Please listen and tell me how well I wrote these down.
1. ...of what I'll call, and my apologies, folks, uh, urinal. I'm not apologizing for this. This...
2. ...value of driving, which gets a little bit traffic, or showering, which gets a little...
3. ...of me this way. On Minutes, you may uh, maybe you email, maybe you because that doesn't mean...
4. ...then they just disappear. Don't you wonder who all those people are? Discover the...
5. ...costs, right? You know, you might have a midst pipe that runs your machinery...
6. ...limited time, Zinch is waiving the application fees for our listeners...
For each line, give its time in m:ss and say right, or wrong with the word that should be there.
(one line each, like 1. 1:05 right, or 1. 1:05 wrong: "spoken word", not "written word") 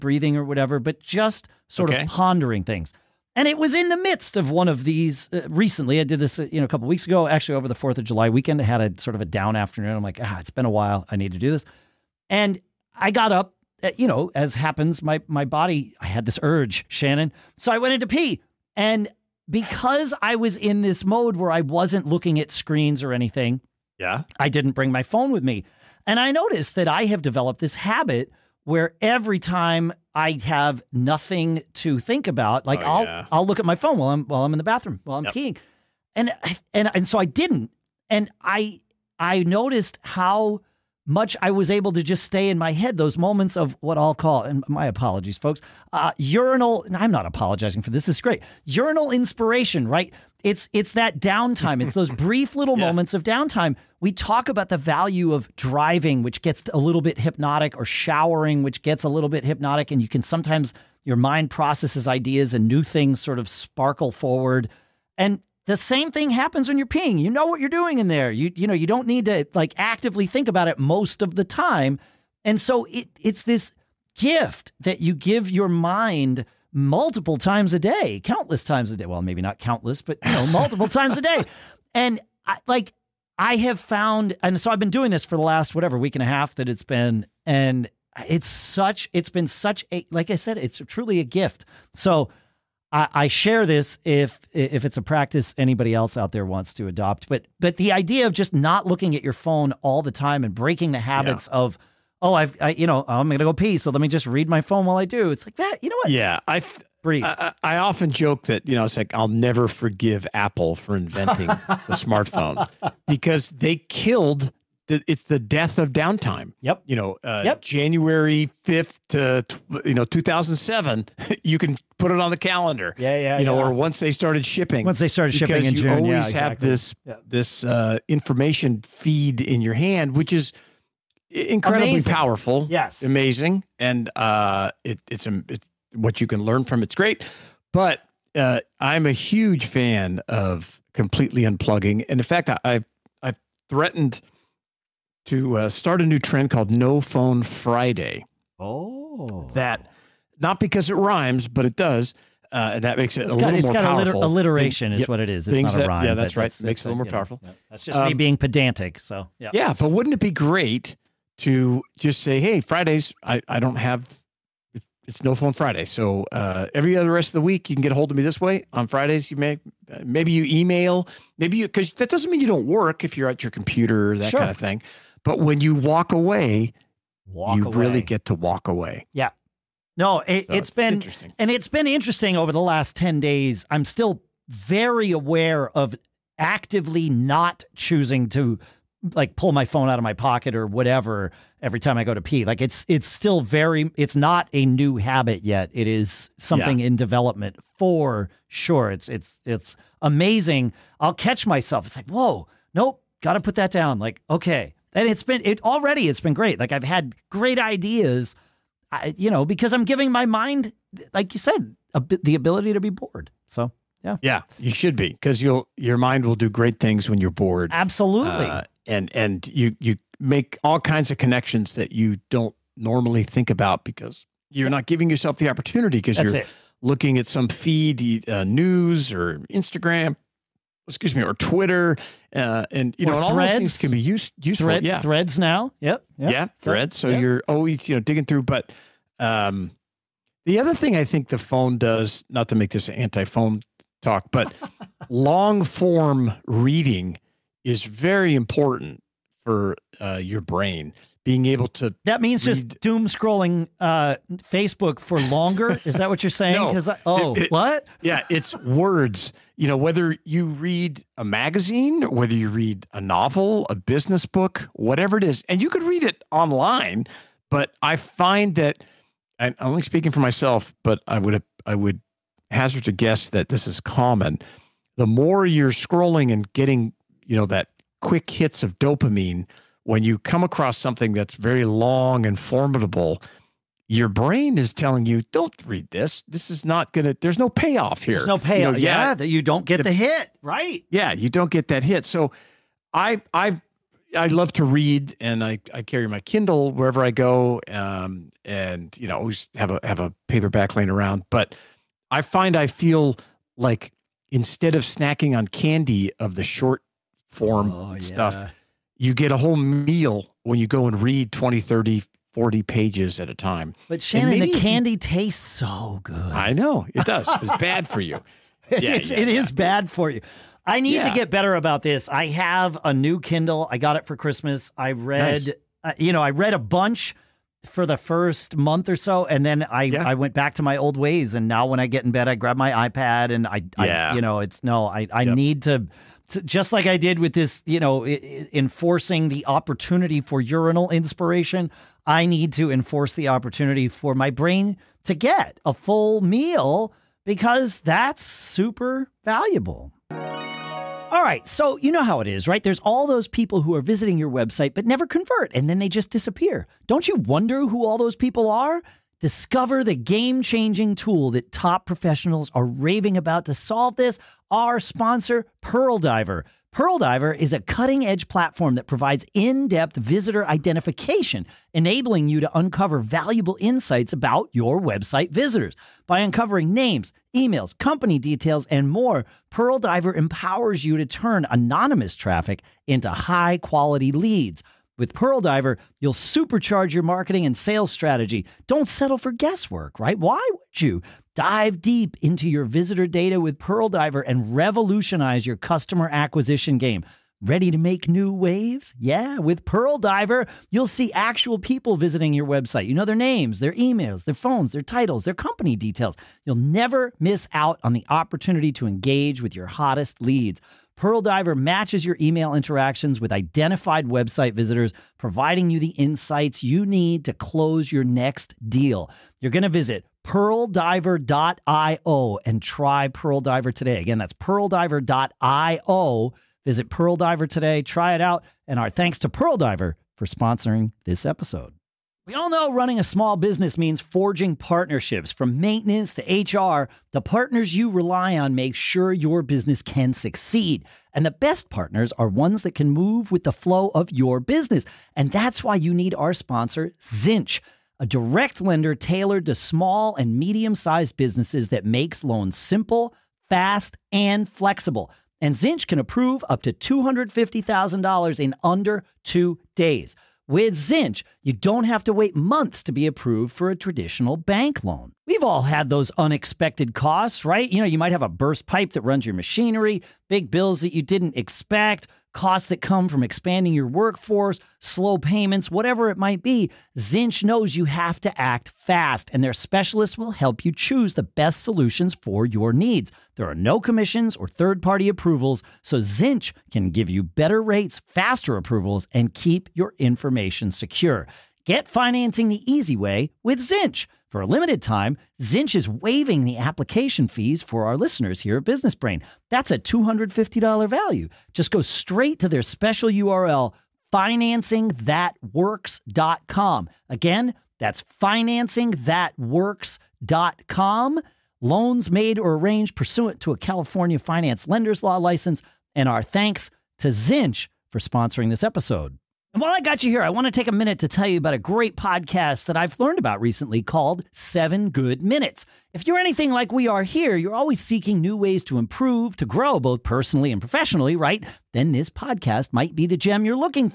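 1. 0:43 right
2. 0:54 wrong: "hypnotic", not "traffic"
3. 2:48 wrong: "Fridays", not "Minutes"
4. 5:55 right
5. 7:46 wrong: "burst", not "midst"
6. 8:14 right.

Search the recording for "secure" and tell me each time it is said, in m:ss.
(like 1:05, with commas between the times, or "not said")
8:10.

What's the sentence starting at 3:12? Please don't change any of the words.
Like it's it's still very it's not a new habit yet.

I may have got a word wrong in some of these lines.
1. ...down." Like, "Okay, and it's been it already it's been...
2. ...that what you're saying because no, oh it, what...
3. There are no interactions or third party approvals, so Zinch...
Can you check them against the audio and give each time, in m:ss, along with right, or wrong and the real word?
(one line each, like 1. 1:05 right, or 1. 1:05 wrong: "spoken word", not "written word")
1. 3:23 right
2. 4:15 right
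3. 8:03 wrong: "commissions", not "interactions".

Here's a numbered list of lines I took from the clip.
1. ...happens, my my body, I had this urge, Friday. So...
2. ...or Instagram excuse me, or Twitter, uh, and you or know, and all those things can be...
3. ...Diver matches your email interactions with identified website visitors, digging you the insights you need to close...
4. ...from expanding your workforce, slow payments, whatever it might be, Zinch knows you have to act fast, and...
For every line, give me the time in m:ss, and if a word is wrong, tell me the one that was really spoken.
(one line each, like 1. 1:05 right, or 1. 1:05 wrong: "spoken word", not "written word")
1. 0:14 wrong: "Shannon", not "Friday"
2. 3:49 right
3. 6:51 wrong: "providing", not "digging"
4. 7:53 right.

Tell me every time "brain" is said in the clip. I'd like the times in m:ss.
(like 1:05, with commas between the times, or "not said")
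4:10, 4:44, 5:44, 8:18.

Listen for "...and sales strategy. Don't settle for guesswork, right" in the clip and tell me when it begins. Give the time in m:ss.
6:27.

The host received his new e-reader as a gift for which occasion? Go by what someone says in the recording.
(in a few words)
Christmas.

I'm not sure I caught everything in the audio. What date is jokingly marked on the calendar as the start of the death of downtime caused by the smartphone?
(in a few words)
January 5th, 2007.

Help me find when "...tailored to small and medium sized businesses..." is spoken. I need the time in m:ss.
7:28.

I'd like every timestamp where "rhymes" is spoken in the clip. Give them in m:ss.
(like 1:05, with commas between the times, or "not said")
2:30, 2:35.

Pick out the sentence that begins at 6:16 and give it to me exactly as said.
By uncovering names, emails, company details, and more, Pearl Diver empowers you to turn anonymous traffic into high quality leads.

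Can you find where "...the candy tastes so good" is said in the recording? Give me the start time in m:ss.
5:14.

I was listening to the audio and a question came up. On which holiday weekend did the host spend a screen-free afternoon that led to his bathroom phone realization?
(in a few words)
4th of July.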